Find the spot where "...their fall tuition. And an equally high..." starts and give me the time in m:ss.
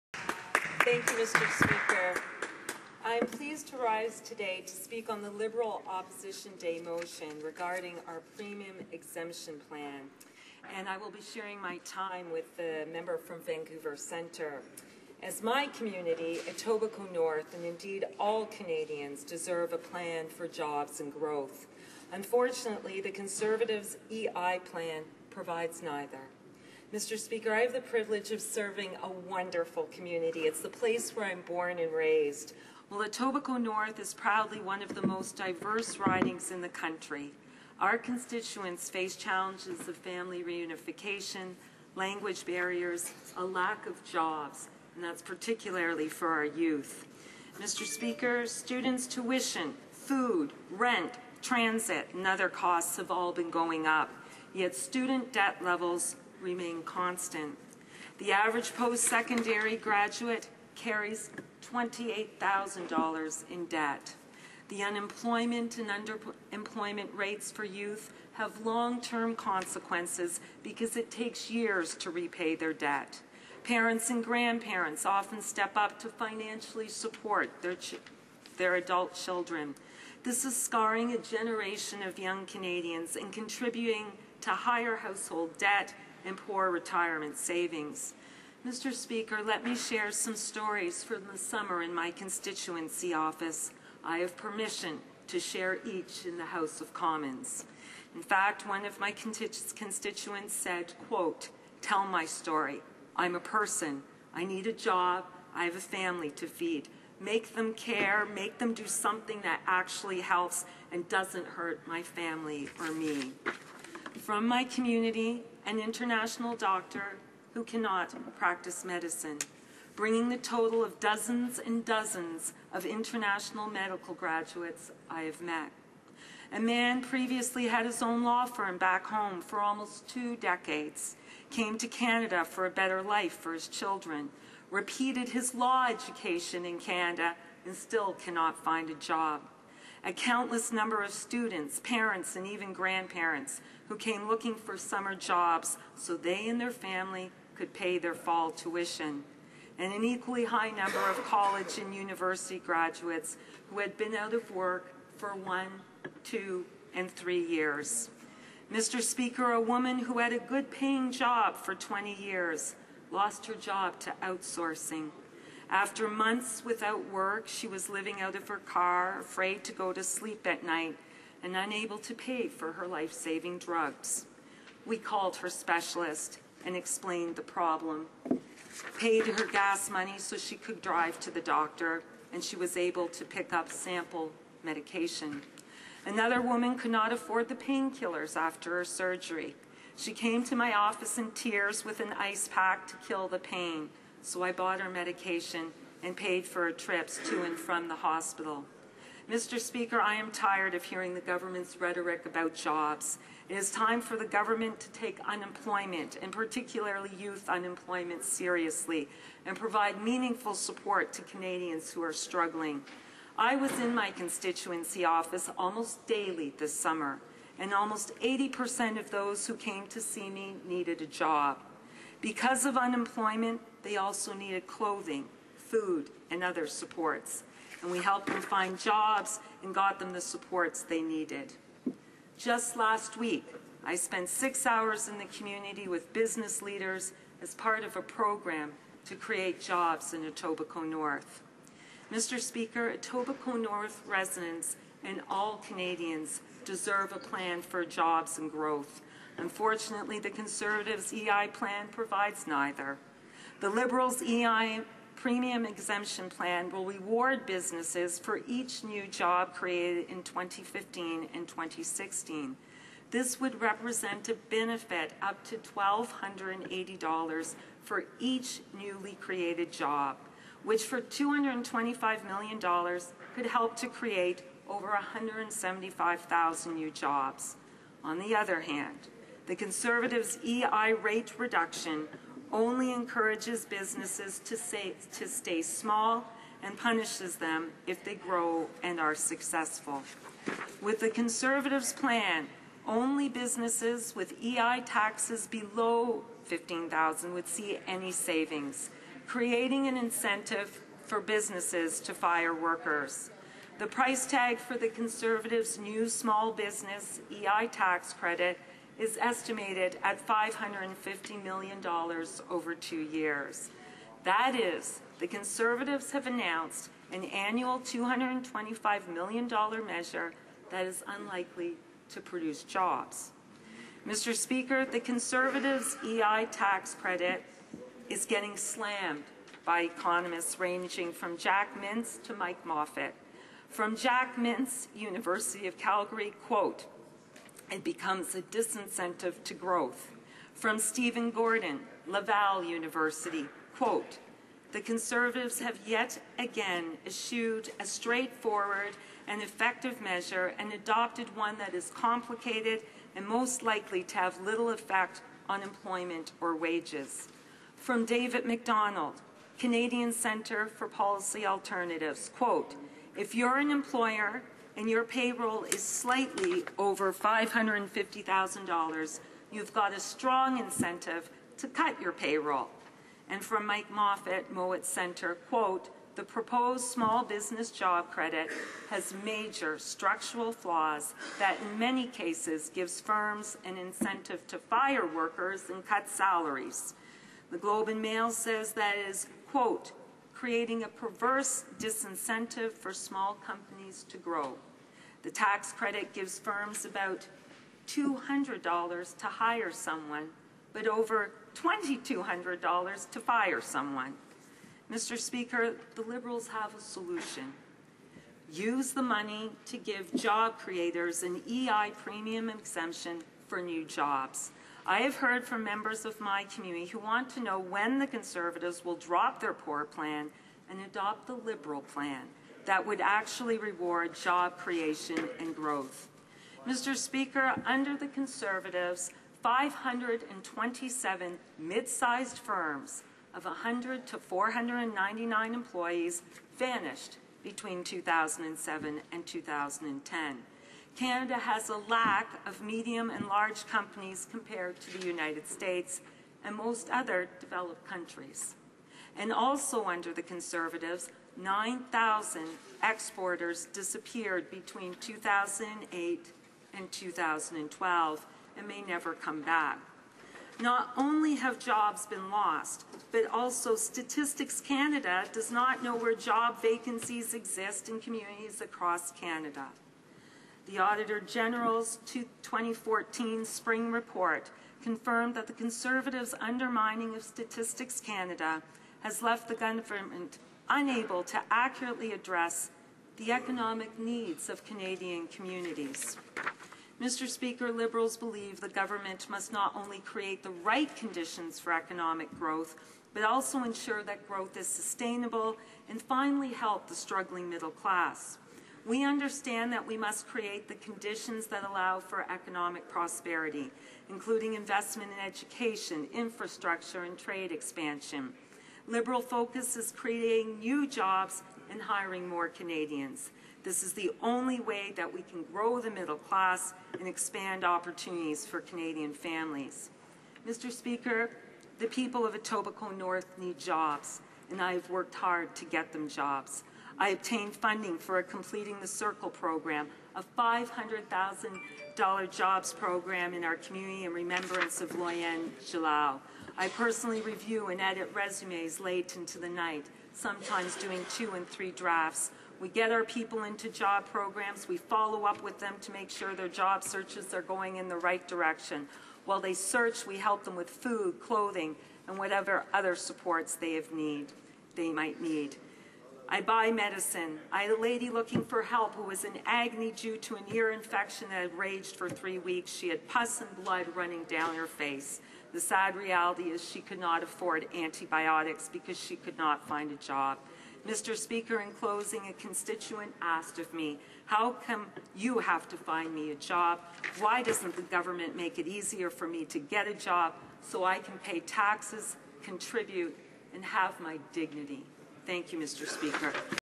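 2:27.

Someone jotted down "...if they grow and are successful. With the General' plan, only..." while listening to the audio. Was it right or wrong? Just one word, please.
wrong.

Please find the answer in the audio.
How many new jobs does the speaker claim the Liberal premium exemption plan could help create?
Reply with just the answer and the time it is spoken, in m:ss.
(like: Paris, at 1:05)
175,000, at 4:34.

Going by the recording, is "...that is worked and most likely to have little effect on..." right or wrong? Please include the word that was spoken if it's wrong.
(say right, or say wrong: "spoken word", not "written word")
wrong: "complicated", not "worked".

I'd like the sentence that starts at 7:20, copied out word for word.
Canada has a lack of medium and large companies compared to the United States and most other developed countries.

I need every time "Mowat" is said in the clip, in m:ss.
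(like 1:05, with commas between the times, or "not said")
6:14.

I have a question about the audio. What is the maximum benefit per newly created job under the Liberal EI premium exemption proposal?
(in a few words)
$1,280.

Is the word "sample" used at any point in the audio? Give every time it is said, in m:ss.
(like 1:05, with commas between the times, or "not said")
3:03.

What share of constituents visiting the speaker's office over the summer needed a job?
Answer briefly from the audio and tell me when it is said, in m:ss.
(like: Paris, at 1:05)
80%, at 3:38.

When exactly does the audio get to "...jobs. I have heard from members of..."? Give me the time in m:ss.
6:53.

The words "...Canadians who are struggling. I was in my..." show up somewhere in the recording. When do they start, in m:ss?
3:31.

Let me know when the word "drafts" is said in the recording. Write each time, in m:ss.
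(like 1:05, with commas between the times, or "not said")
9:01.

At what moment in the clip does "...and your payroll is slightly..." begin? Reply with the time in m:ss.
6:04.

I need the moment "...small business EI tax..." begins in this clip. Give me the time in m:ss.
5:06.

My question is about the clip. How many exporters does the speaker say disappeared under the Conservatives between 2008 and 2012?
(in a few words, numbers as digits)
9,000.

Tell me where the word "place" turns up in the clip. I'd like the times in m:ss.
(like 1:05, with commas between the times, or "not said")
0:30.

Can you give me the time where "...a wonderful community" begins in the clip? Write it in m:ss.
0:29.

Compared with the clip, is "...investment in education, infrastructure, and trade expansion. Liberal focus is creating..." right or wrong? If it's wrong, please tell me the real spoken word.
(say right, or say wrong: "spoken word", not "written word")
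right.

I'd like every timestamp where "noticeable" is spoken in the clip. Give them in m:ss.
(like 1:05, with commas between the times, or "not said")
not said.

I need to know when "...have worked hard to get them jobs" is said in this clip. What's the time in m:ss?
8:44.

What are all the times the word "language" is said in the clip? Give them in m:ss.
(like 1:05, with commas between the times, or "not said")
0:41.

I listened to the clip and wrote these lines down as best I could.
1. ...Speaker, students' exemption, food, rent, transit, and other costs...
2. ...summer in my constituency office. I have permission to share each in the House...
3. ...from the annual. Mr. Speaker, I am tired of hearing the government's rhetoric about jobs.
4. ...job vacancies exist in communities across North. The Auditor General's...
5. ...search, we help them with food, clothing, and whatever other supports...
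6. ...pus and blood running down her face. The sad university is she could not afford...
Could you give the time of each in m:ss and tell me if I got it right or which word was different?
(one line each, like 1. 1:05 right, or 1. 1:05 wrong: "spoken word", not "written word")
1. 0:47 wrong: "tuition", not "exemption"
2. 1:31 right
3. 3:17 wrong: "hospital", not "annual"
4. 7:46 wrong: "Canada", not "North"
5. 9:09 right
6. 9:23 wrong: "reality", not "university".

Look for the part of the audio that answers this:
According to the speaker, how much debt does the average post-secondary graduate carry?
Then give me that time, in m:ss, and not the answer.
1:01.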